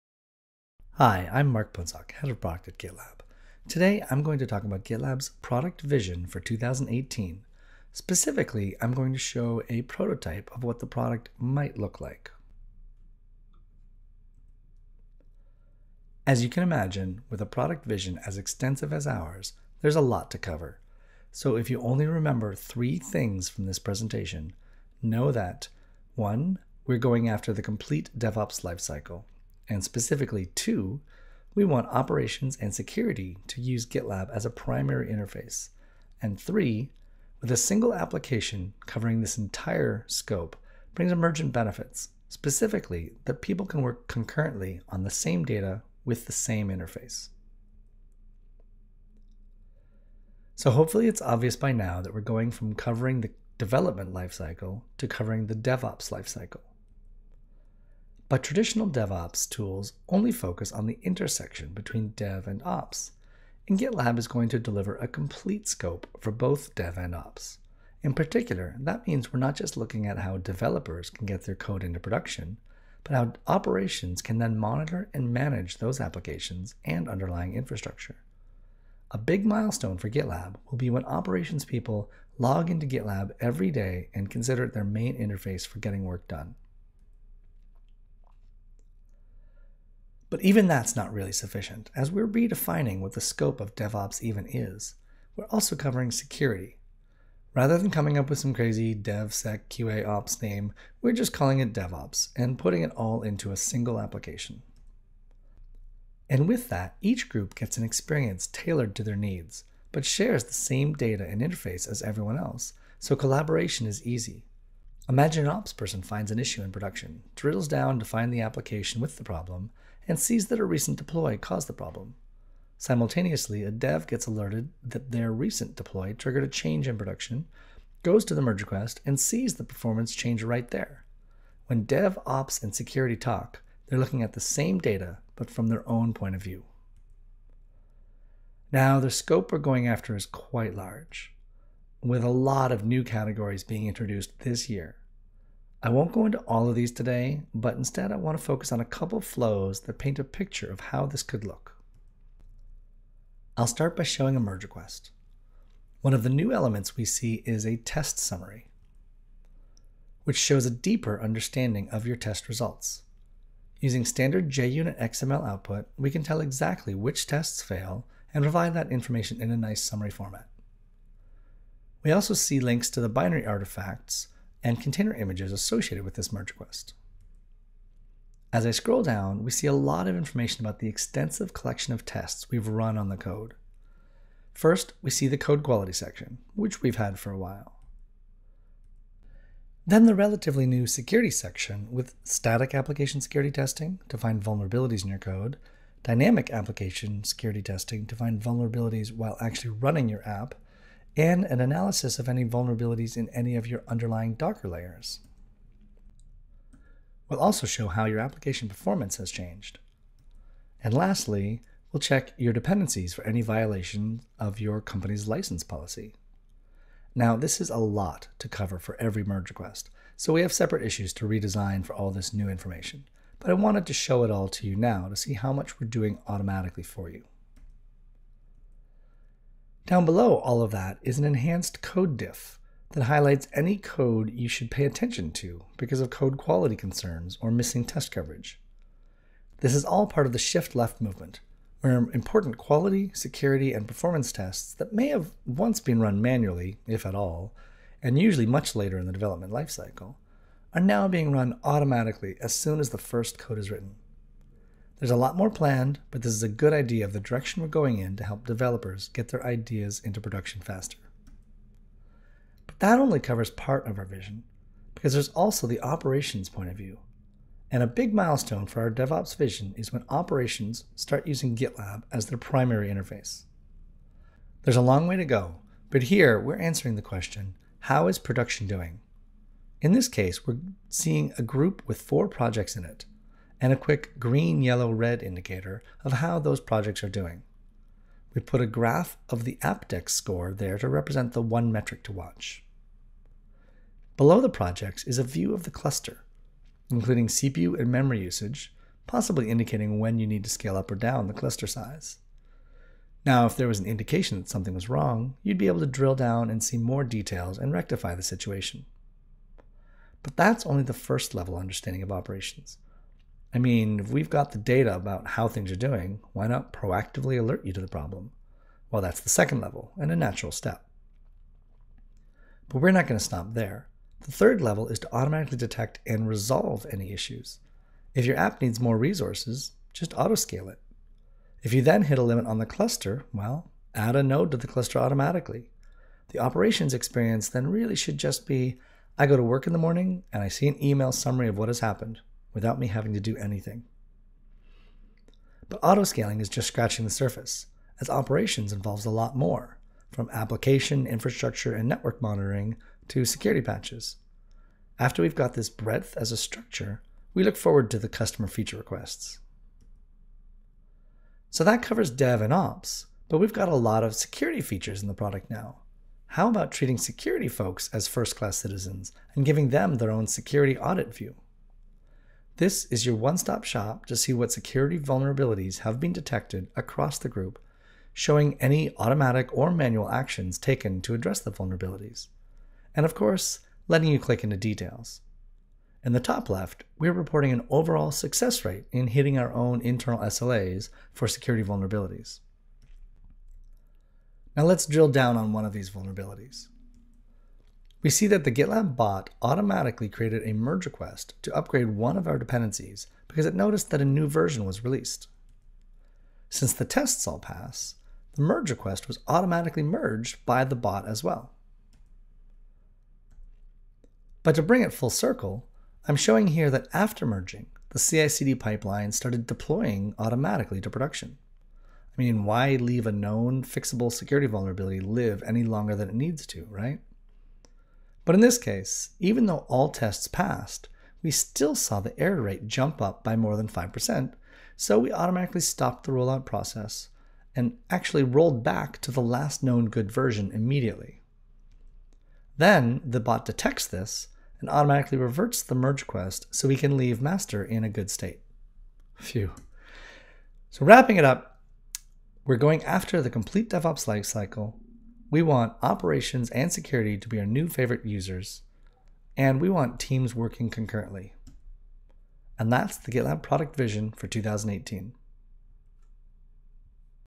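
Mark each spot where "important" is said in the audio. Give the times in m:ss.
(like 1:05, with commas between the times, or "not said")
4:01.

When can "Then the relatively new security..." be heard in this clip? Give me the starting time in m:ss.
3:09.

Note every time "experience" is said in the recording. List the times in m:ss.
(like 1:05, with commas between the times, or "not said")
1:47, 5:36.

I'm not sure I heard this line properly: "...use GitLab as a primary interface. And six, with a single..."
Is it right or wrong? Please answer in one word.
wrong.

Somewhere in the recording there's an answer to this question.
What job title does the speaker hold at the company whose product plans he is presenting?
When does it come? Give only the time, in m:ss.
0:02.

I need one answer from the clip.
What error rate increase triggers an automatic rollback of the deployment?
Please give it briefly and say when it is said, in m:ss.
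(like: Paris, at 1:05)
5%, at 7:13.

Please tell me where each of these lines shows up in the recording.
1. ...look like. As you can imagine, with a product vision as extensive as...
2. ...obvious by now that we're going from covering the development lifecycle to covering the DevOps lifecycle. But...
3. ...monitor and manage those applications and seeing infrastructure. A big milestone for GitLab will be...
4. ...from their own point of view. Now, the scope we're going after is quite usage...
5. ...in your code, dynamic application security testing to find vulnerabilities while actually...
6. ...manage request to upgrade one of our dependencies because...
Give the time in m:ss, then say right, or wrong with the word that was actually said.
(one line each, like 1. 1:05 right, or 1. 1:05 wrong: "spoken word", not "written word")
1. 0:11 right
2. 0:51 right
3. 1:14 wrong: "underlying", not "seeing"
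4. 2:15 wrong: "large", not "usage"
5. 3:15 right
6. 6:40 wrong: "merge", not "manage".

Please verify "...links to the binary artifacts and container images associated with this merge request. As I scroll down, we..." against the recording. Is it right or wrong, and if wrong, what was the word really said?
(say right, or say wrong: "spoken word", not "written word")
right.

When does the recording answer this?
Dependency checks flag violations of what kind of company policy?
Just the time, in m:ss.
3:35.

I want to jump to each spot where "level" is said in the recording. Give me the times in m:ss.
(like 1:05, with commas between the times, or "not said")
5:11, 5:19, 5:24.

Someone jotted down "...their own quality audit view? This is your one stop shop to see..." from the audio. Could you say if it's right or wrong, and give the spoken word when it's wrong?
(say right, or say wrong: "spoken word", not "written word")
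wrong: "security", not "quality".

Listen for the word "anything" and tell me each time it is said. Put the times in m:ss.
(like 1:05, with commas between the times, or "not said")
5:43.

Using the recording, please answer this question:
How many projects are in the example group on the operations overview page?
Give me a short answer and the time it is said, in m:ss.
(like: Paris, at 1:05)
4, at 4:42.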